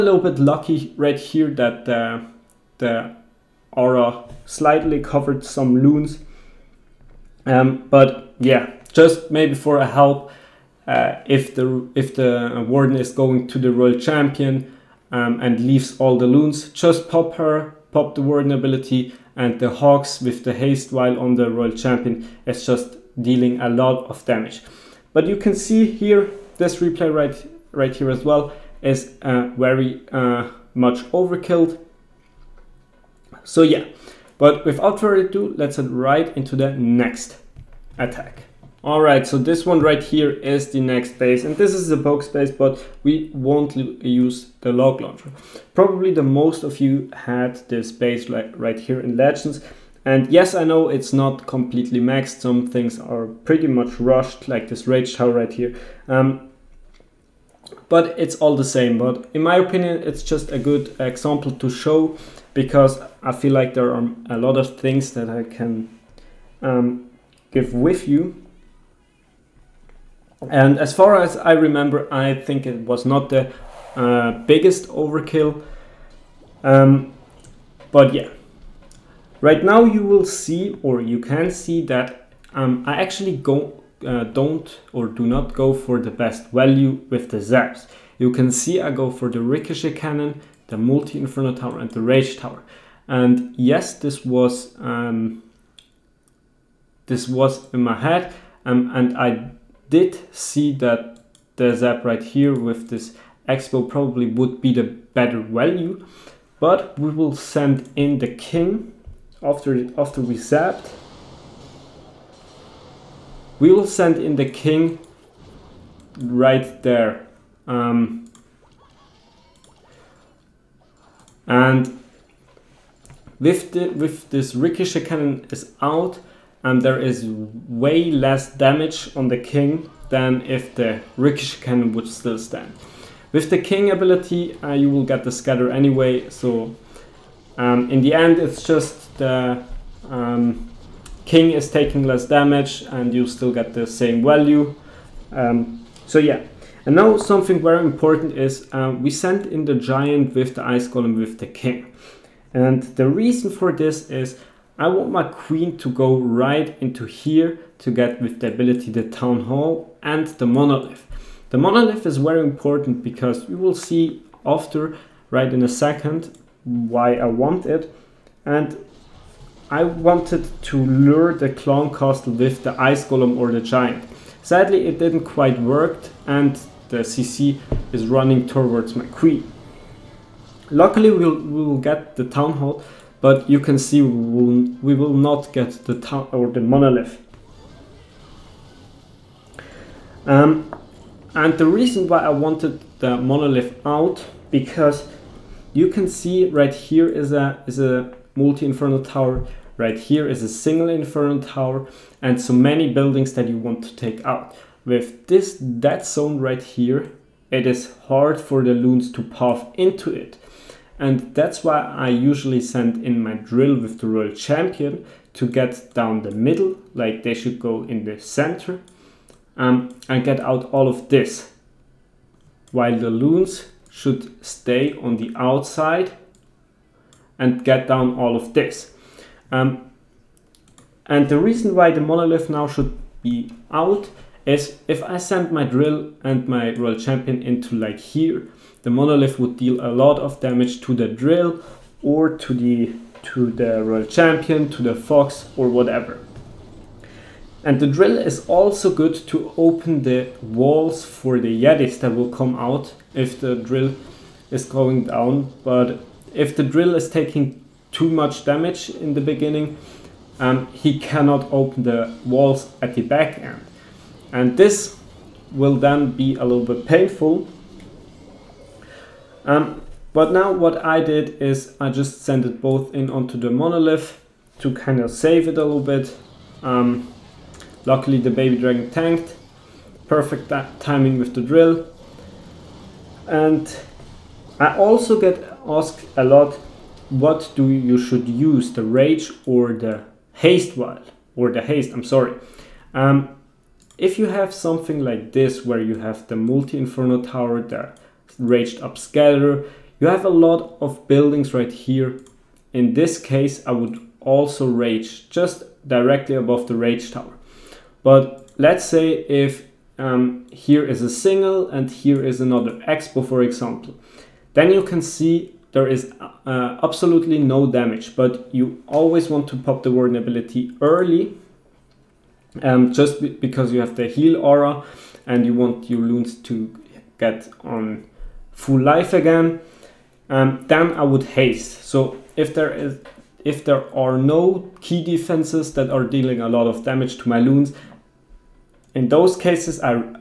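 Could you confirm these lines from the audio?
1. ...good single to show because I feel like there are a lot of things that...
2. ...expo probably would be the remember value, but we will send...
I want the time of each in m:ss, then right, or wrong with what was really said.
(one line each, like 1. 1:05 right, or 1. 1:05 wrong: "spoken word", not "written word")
1. 1:00 wrong: "example", not "single"
2. 1:43 wrong: "better", not "remember".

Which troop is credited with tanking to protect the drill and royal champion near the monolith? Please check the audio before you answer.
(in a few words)
Baby dragon.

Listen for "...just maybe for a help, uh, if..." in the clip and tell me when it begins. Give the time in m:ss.
0:08.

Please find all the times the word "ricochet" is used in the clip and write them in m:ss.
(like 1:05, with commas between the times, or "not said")
1:29, 2:04, 2:11.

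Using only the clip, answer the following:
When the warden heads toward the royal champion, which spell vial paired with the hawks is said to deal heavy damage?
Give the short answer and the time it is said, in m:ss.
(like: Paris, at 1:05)
Haste vial, at 0:20.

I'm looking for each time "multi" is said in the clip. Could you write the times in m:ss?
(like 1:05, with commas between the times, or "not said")
1:30, 3:18, 4:56.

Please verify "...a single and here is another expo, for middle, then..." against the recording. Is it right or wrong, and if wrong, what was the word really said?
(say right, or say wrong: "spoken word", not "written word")
wrong: "example", not "middle".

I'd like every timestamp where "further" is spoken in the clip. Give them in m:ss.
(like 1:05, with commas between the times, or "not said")
0:34.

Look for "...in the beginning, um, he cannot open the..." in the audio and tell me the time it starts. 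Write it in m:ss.
4:18.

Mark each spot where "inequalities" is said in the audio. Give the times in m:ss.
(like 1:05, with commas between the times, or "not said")
not said.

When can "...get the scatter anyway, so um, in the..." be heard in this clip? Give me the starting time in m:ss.
2:15.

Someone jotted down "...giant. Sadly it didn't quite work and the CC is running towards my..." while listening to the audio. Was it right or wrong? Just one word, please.
right.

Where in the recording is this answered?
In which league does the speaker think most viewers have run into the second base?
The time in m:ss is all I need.
0:49.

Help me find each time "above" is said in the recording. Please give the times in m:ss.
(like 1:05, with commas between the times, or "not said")
5:06.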